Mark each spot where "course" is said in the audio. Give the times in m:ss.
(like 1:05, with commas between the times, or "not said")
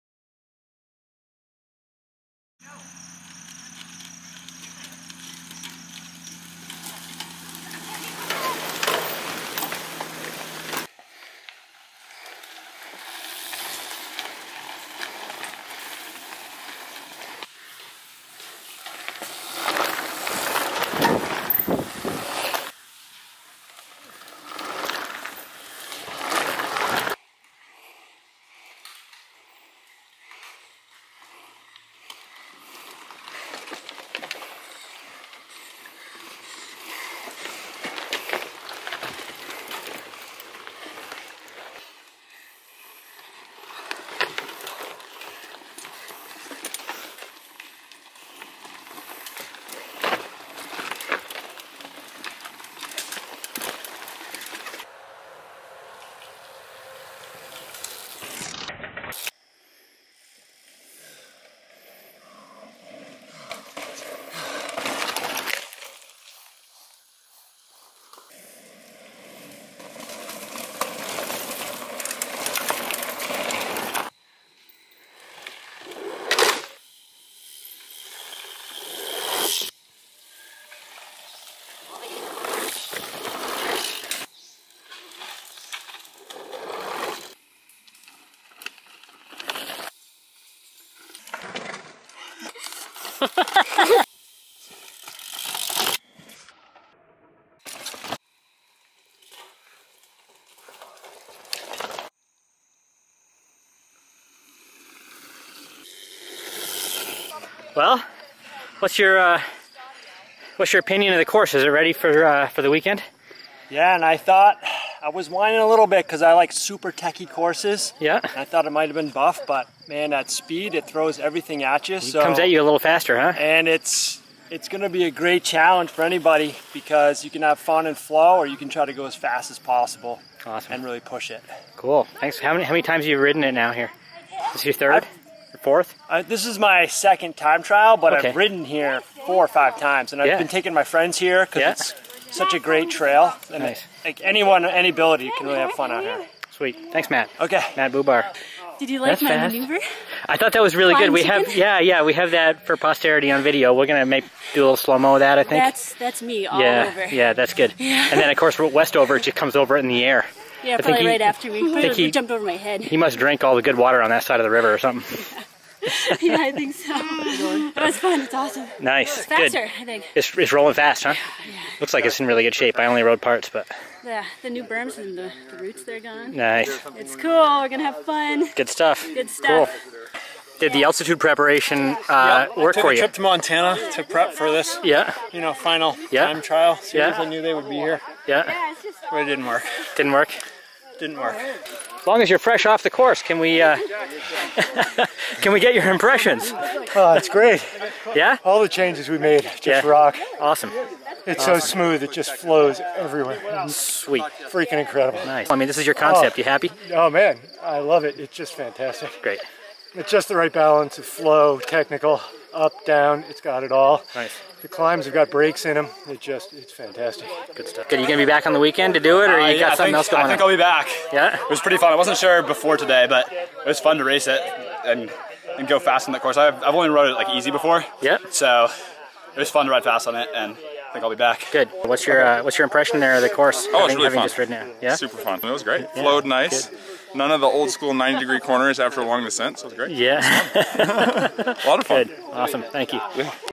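1:51, 1:57, 2:38, 3:12, 3:46, 3:53.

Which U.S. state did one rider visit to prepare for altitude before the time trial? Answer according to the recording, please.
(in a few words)
Montana.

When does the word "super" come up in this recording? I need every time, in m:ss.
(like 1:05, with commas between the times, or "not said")
1:56, 3:54.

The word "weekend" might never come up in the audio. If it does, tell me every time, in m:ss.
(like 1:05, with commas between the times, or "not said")
1:52, 3:38.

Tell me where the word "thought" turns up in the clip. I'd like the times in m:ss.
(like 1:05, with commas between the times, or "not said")
1:54, 1:58, 2:30.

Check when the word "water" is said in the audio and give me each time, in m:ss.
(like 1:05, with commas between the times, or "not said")
2:43.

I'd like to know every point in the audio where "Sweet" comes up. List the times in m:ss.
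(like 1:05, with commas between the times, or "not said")
2:26, 3:23.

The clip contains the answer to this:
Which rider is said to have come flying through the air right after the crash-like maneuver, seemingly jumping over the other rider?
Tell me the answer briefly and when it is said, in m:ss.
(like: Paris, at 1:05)
Westover, at 2:38.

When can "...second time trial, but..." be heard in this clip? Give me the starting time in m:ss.
2:16.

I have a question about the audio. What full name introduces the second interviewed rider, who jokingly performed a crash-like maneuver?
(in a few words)
Matt Bubar.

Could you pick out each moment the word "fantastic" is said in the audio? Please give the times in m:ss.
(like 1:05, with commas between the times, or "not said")
3:28, 3:36.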